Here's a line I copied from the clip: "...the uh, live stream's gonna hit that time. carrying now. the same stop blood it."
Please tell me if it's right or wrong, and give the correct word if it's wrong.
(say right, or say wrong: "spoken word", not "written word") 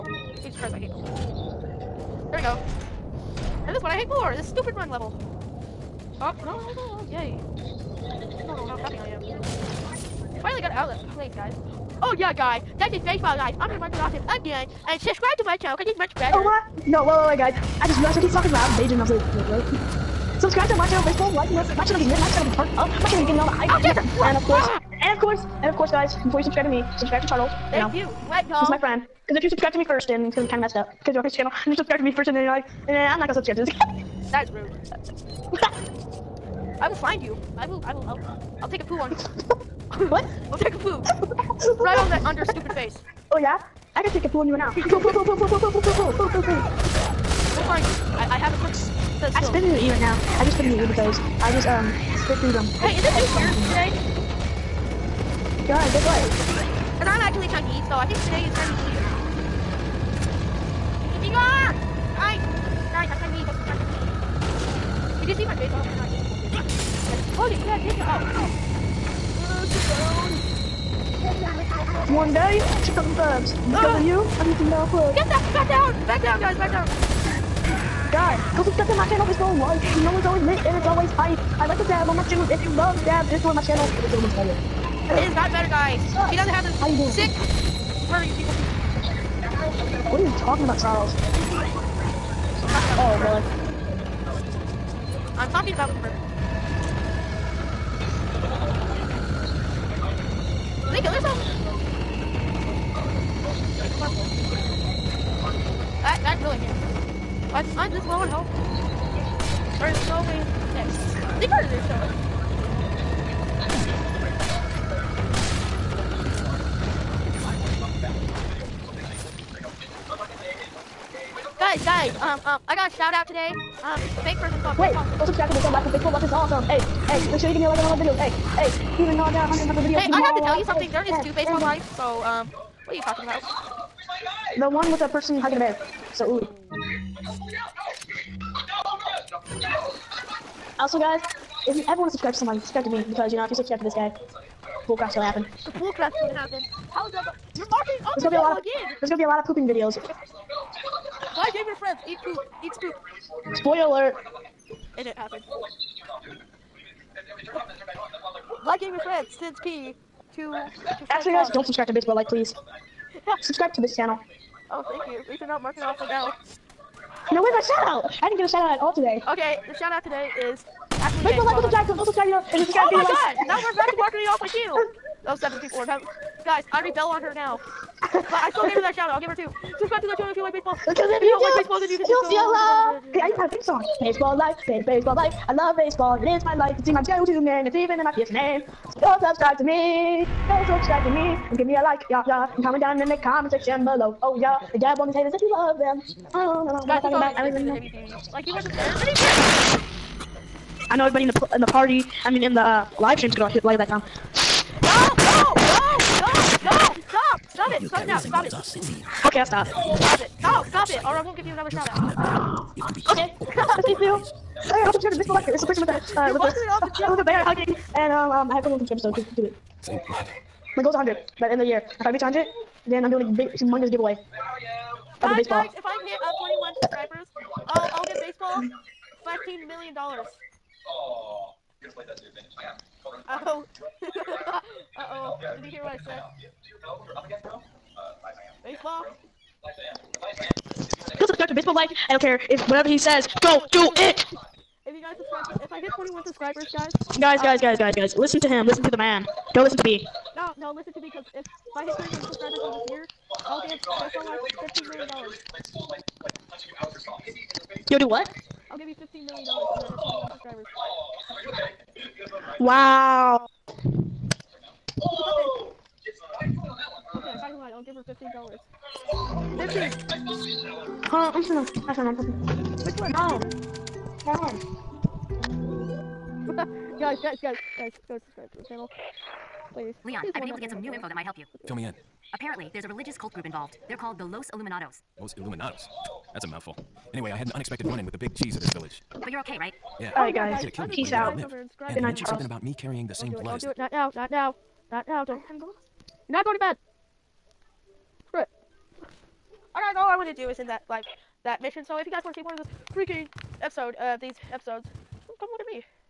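right.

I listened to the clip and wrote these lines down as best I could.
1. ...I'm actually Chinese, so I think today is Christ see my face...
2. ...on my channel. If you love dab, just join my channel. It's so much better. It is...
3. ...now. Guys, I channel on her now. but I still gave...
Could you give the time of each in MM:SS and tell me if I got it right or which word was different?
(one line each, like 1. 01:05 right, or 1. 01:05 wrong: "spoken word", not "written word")
1. 00:57 wrong: "Chinese", not "Christ"
2. 01:22 right
3. 02:55 wrong: "rebel", not "channel".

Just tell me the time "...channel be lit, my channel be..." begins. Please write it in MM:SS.
00:21.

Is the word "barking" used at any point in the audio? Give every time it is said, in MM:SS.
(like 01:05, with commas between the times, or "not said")
02:27.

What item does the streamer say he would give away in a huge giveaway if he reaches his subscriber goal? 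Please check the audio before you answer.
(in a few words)
a baseball.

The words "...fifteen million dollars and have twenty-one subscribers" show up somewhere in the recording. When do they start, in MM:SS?
04:18.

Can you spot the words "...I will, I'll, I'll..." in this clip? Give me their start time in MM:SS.
00:37.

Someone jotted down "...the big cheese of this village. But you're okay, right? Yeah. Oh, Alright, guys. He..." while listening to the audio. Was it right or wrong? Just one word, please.
right.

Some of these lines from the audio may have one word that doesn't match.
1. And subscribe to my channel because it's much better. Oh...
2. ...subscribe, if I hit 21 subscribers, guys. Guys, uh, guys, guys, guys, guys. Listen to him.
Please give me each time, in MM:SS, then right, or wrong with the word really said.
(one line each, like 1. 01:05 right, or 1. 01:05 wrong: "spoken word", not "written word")
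1. 00:14 right
2. 04:05 right.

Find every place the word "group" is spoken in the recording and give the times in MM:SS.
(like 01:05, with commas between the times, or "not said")
04:43.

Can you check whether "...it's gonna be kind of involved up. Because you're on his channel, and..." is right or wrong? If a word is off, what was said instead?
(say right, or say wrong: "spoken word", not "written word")
wrong: "messed", not "involved".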